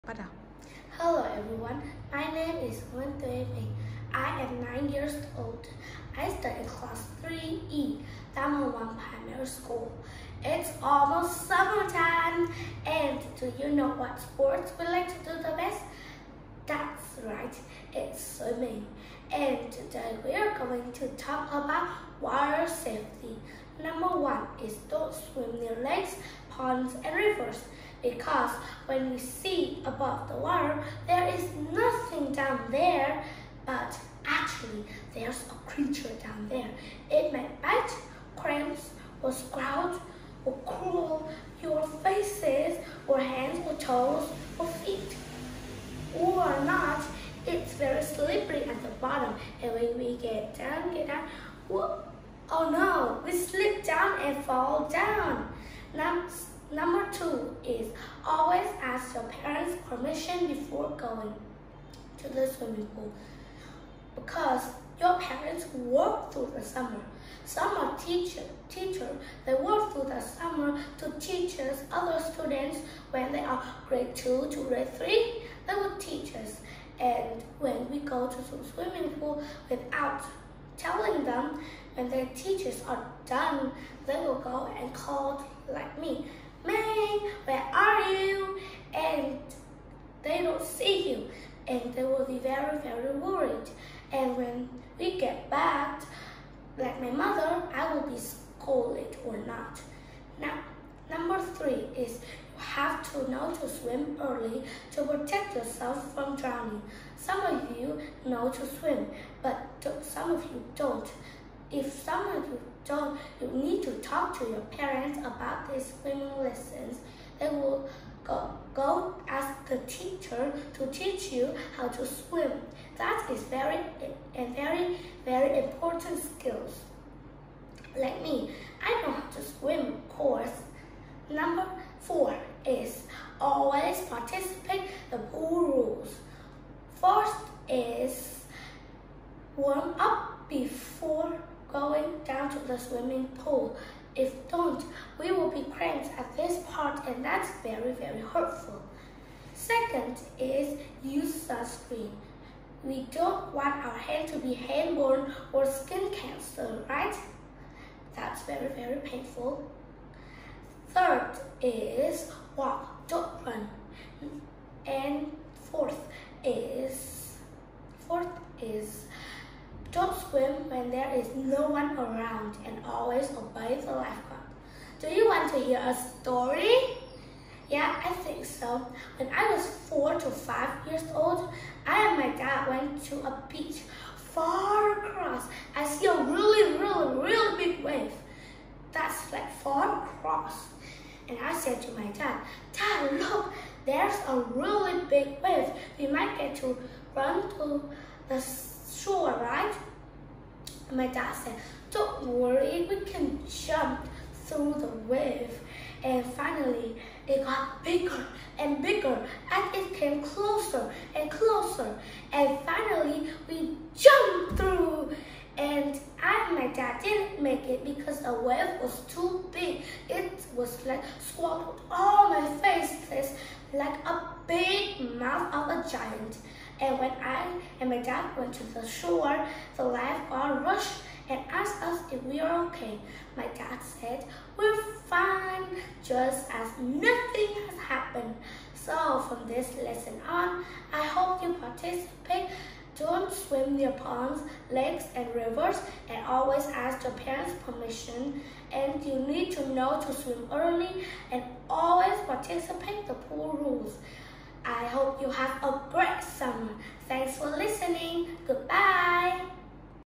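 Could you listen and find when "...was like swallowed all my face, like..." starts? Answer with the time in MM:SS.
03:40.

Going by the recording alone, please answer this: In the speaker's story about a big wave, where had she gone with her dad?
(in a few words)
A beach.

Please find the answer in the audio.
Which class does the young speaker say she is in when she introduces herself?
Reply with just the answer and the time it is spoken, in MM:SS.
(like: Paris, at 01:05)
3E, at 00:07.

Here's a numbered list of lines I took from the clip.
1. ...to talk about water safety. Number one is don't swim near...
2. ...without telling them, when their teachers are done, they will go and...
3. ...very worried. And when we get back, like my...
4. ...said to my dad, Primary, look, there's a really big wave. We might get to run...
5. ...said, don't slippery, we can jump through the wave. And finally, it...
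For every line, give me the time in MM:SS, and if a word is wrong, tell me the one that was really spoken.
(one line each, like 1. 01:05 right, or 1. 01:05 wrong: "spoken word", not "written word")
1. 00:20 right
2. 01:19 right
3. 01:32 right
4. 03:11 wrong: "Dad", not "Primary"
5. 03:21 wrong: "worry", not "slippery".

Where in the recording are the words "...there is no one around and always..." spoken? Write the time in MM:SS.
02:50.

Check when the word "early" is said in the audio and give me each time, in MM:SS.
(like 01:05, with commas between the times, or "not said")
01:44, 04:10.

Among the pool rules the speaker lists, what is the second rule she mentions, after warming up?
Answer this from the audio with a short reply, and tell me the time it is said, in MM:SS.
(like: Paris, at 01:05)
Use sunscreen, at 02:31.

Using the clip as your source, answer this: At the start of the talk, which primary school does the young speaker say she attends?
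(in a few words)
Tam Hồng 1 Primary School.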